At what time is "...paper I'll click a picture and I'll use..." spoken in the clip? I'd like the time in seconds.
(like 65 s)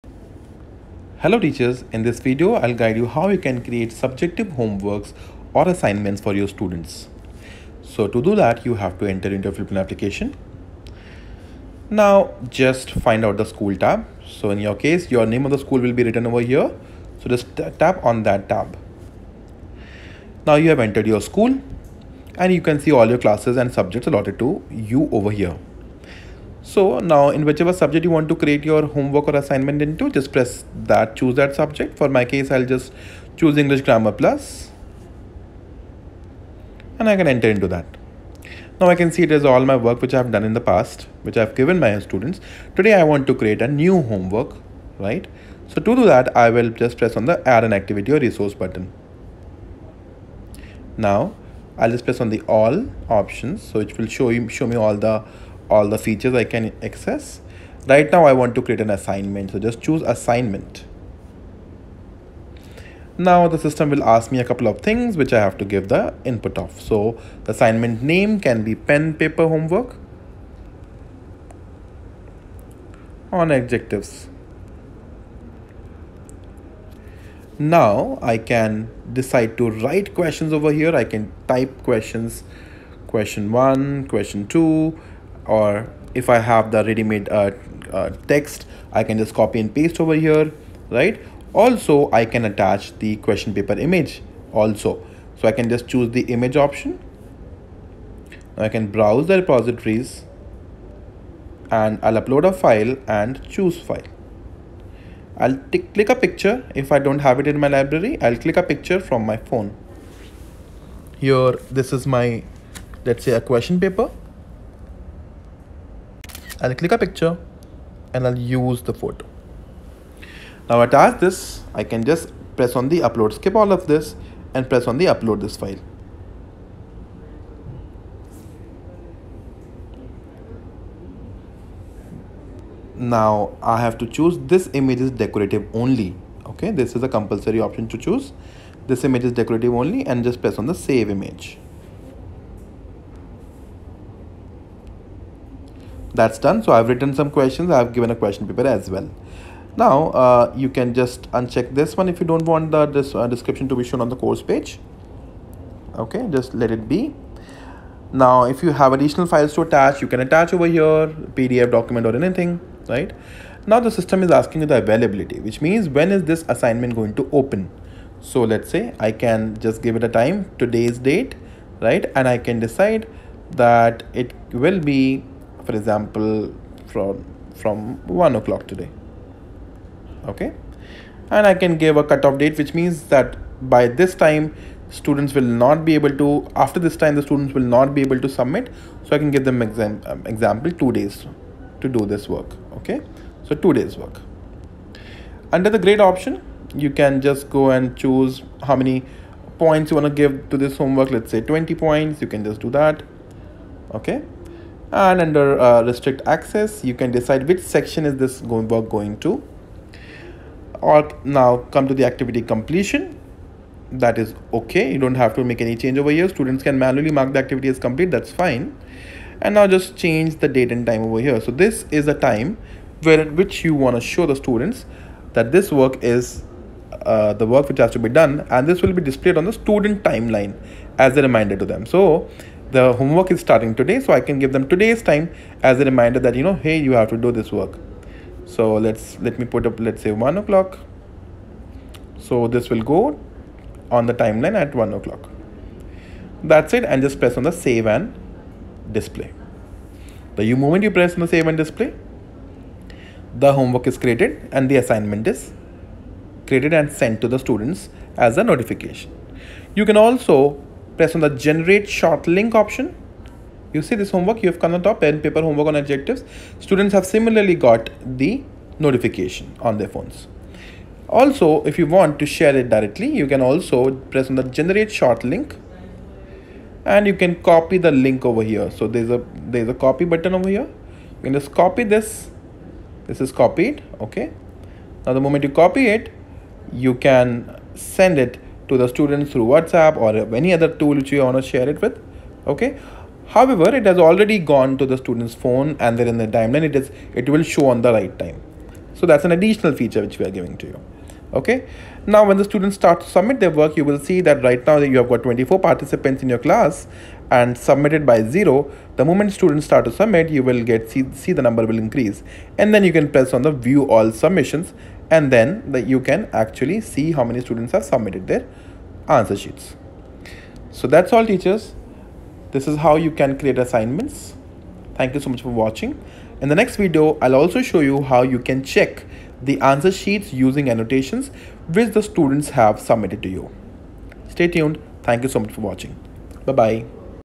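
113 s.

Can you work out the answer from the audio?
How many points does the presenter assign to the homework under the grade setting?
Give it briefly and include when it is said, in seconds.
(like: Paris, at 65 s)
20, at 201 s.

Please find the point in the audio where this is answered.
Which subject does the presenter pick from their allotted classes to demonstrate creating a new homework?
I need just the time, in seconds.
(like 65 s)
33 s.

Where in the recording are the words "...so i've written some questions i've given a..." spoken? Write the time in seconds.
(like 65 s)
146 s.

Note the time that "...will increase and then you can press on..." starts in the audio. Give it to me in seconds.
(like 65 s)
311 s.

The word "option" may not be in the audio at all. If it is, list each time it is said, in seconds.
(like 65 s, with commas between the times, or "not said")
53 s, 96 s, 137 s, 196 s, 262 s.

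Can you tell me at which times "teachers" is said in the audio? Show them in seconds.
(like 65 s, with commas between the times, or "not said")
1 s, 321 s.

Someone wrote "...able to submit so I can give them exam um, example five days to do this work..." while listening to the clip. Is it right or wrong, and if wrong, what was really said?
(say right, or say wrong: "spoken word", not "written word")
wrong: "two", not "five".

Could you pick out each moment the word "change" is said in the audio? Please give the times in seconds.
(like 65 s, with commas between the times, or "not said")
215 s, 219 s.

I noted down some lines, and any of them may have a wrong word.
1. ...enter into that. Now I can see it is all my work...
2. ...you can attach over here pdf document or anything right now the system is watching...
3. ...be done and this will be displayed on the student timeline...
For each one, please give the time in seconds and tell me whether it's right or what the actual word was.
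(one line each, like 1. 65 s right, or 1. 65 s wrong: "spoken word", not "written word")
1. 37 s right
2. 160 s wrong: "asking", not "watching"
3. 227 s right.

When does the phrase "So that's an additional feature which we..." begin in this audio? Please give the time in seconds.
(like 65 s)
298 s.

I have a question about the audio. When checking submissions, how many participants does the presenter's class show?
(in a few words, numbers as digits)
24.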